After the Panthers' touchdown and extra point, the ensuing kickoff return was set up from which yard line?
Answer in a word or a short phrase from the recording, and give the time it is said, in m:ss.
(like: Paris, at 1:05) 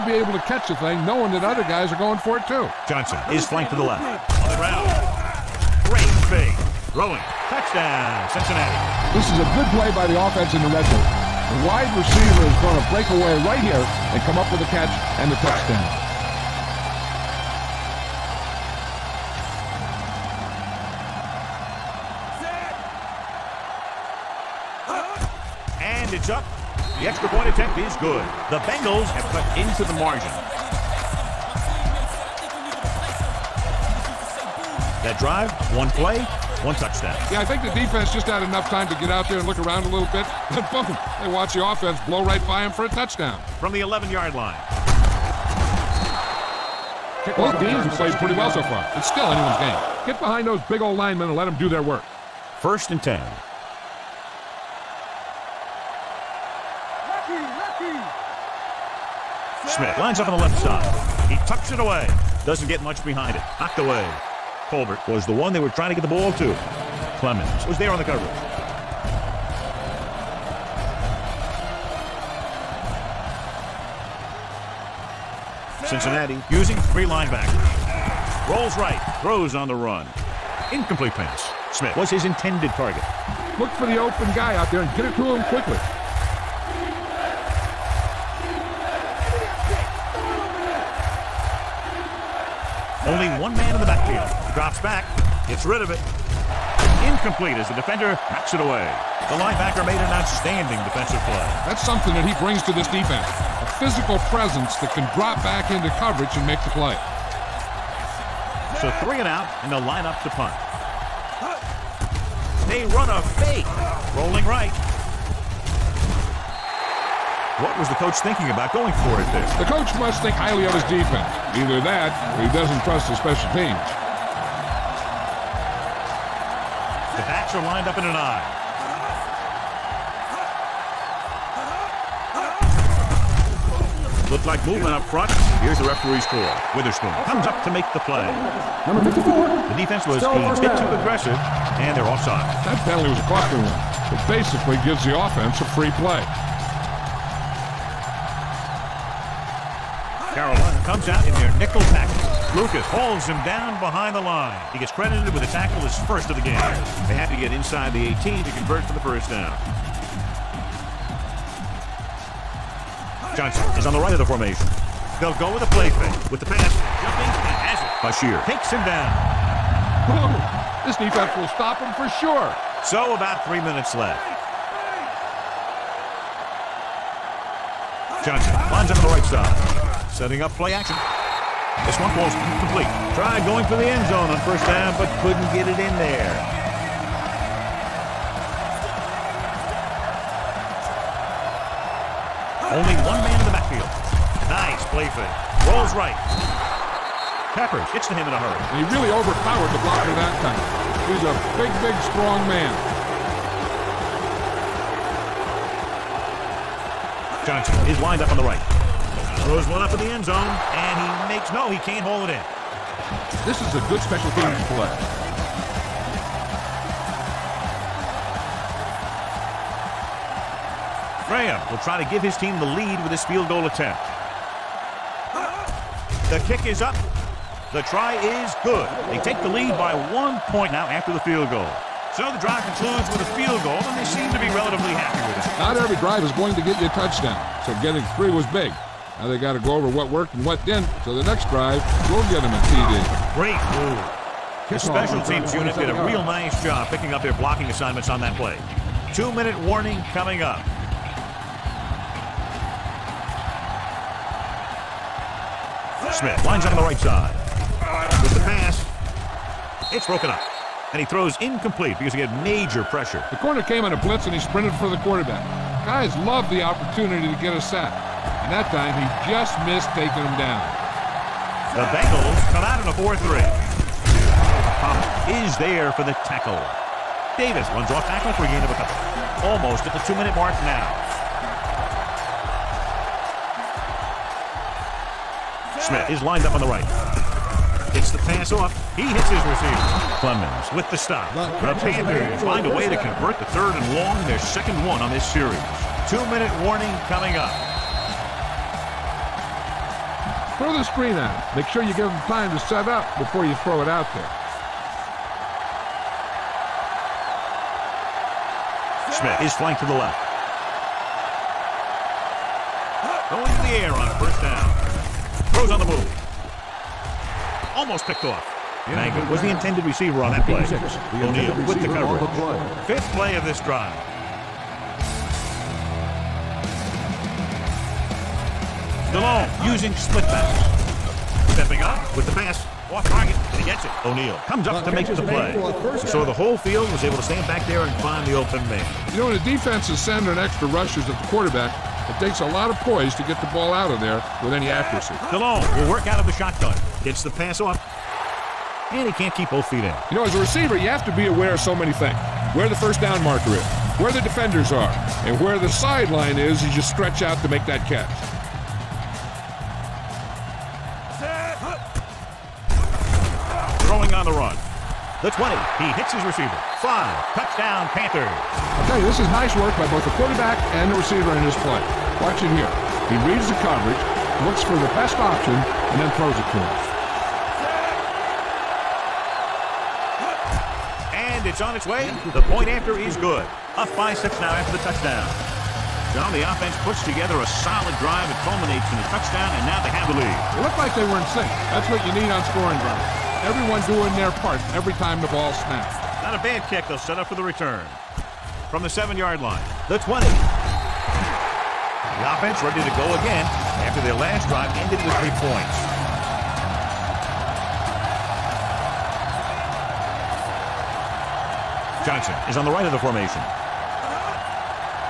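7, at 6:38.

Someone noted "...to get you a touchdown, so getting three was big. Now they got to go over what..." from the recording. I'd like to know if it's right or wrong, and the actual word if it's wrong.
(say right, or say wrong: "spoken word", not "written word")
right.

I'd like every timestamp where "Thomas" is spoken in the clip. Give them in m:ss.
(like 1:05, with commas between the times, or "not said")
4:34.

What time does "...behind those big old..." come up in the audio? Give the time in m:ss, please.
0:50.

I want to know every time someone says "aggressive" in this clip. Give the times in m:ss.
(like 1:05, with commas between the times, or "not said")
2:21.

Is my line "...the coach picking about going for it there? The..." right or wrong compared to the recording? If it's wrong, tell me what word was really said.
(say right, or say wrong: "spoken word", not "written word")
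wrong: "thinking", not "picking".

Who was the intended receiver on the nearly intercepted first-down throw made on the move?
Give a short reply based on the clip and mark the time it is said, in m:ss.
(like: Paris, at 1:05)
Mangum, at 5:18.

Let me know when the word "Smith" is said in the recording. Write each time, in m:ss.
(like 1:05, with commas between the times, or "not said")
0:59, 1:21, 4:16, 4:45, 5:09.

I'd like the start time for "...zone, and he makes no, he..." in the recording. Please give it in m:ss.
3:30.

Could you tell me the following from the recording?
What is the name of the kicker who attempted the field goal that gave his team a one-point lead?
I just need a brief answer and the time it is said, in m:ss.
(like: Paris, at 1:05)
Graham, at 3:41.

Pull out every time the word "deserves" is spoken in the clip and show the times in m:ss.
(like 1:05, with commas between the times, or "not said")
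not said.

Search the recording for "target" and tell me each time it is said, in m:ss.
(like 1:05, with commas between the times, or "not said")
1:22, 5:33.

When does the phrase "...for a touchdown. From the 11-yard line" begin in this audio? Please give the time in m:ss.
0:42.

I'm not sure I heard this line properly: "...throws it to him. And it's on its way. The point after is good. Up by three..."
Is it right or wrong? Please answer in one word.
wrong.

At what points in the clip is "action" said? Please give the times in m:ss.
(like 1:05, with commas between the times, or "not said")
3:00.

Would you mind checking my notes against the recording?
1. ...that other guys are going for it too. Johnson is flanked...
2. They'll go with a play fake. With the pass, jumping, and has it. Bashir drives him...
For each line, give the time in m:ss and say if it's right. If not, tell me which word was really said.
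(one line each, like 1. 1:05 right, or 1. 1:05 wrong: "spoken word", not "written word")
1. 0:01 right
2. 2:45 wrong: "takes", not "drives".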